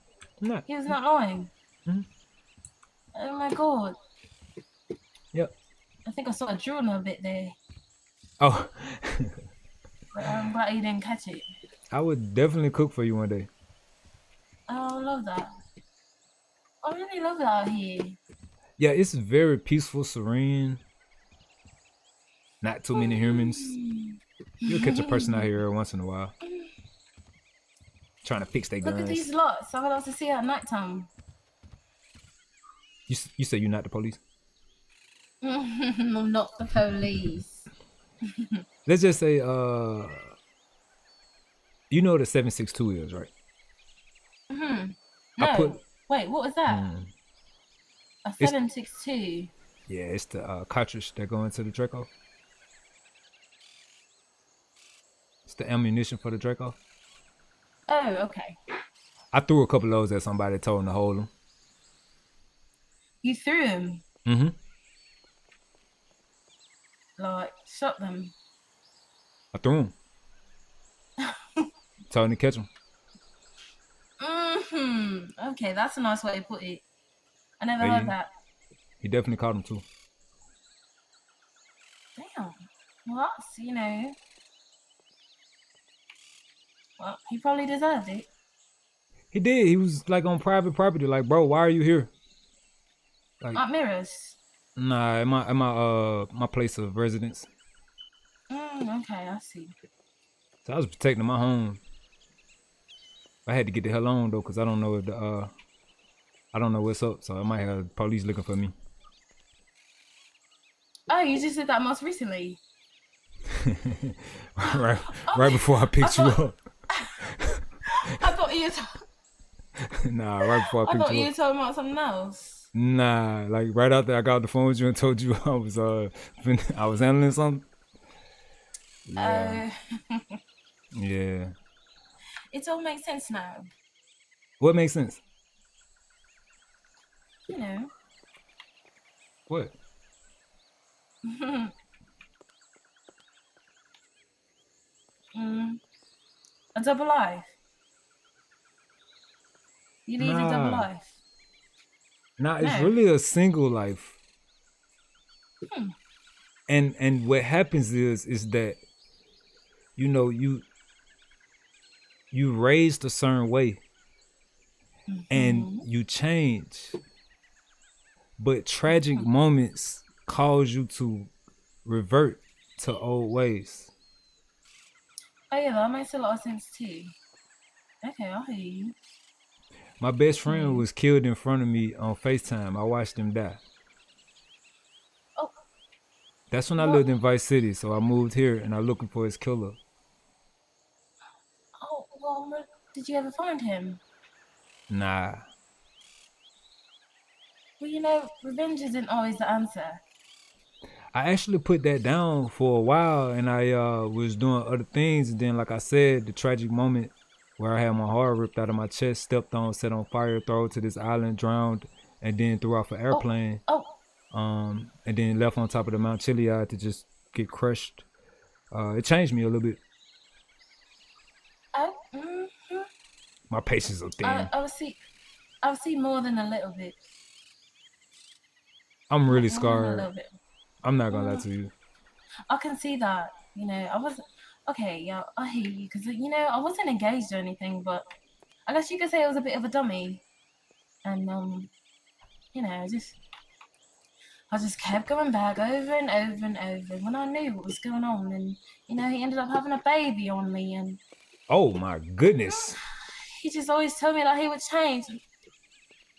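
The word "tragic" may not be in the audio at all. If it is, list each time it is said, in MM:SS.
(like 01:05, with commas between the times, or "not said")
02:48, 03:26.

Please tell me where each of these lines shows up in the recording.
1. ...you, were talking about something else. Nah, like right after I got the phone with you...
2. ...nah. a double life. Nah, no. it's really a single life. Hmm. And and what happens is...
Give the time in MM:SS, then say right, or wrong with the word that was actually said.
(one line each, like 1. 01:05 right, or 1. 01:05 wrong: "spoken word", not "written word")
1. 02:01 right
2. 02:30 right.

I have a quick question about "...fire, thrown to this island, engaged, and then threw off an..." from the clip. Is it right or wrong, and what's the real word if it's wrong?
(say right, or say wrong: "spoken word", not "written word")
wrong: "drowned", not "engaged".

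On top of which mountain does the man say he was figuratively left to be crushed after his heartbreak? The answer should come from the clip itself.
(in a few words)
Mount Chiliad.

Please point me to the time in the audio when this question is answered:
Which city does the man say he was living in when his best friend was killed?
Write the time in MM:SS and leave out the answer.
03:07.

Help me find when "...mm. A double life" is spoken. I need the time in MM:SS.
02:25.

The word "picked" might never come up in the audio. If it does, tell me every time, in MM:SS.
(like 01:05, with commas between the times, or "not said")
01:55, 02:00.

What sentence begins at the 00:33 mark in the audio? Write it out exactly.
You, you say you're not the police?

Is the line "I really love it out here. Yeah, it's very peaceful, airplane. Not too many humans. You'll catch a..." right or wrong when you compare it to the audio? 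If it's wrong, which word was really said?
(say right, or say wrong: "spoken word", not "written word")
wrong: "serene", not "airplane".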